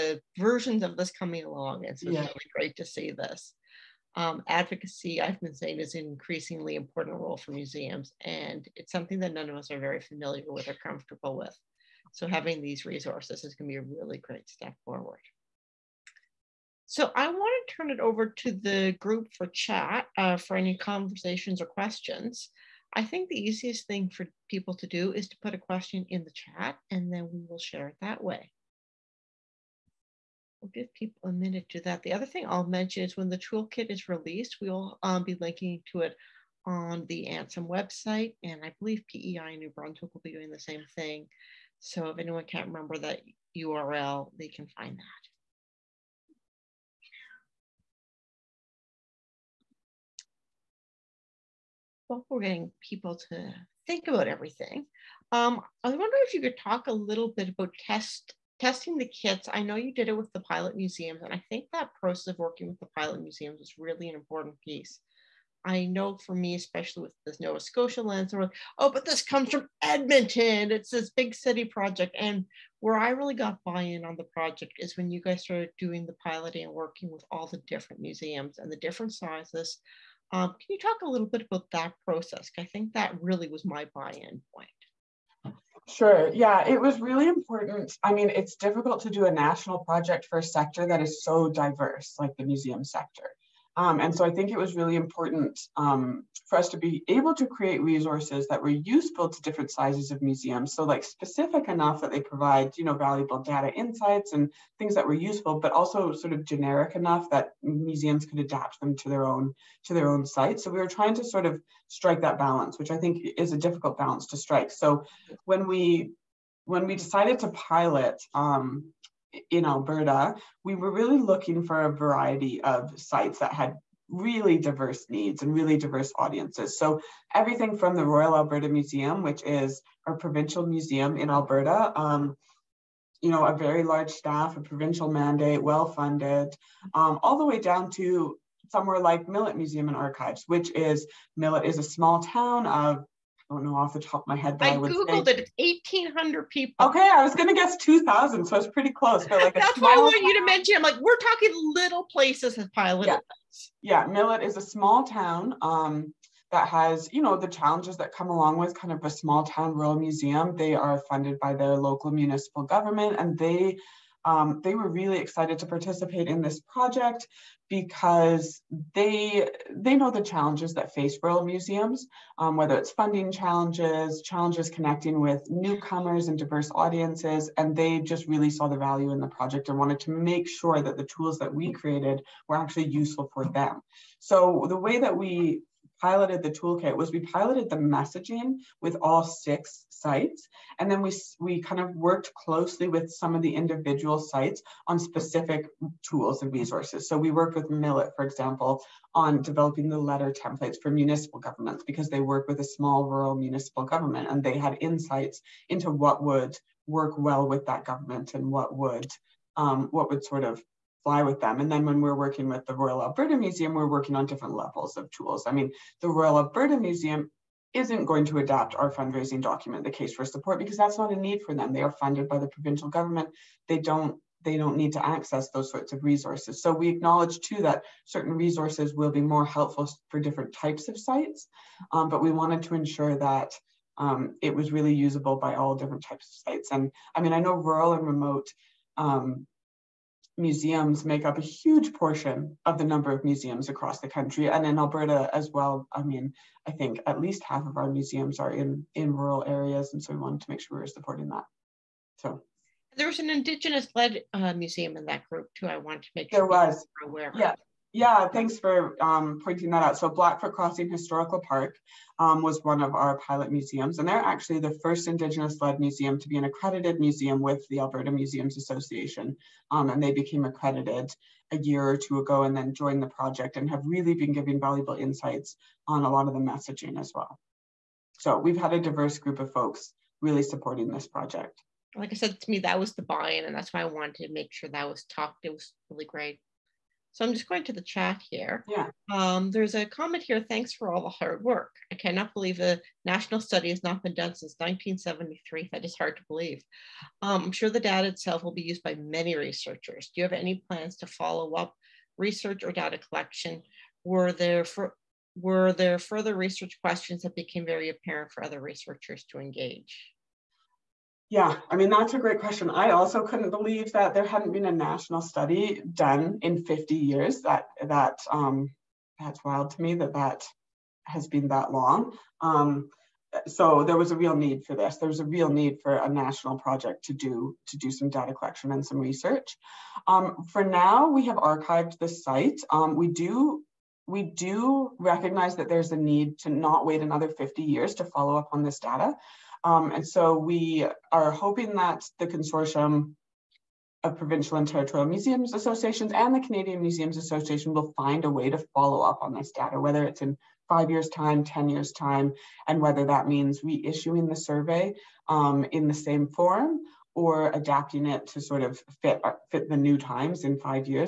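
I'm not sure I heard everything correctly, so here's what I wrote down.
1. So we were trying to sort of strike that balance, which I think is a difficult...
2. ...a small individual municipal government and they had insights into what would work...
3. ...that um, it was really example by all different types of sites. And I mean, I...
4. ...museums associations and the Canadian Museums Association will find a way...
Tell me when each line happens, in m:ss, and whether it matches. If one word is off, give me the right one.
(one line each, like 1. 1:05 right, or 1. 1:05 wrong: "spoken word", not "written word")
1. 1:50 right
2. 3:22 wrong: "rural", not "individual"
3. 3:53 wrong: "usable", not "example"
4. 5:45 right.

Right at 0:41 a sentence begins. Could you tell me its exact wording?
So if anyone can't remember that URL, they can find that.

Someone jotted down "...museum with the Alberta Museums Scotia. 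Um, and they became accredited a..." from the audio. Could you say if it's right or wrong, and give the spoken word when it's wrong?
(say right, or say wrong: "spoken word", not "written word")
wrong: "Association", not "Scotia".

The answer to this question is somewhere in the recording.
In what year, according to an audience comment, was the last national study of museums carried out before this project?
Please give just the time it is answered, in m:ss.
4:54.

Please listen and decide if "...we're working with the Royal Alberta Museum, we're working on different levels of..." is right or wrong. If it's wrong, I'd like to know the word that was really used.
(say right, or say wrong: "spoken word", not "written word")
right.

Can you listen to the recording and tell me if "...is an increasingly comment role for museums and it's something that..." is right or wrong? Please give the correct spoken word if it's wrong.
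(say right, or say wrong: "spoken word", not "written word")
wrong: "important", not "comment".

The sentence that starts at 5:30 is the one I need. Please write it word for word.
Um, for now, we have archived the site.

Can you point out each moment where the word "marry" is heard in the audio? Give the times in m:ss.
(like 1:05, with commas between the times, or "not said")
not said.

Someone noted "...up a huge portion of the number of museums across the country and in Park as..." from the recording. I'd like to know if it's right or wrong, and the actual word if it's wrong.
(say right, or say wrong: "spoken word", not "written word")
wrong: "Alberta", not "Park".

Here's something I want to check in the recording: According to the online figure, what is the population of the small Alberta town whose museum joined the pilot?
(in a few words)
1,800.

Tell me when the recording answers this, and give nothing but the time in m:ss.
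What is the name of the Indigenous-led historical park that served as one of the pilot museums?
4:20.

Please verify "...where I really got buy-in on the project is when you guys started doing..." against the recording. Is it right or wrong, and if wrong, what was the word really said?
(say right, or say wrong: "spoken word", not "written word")
right.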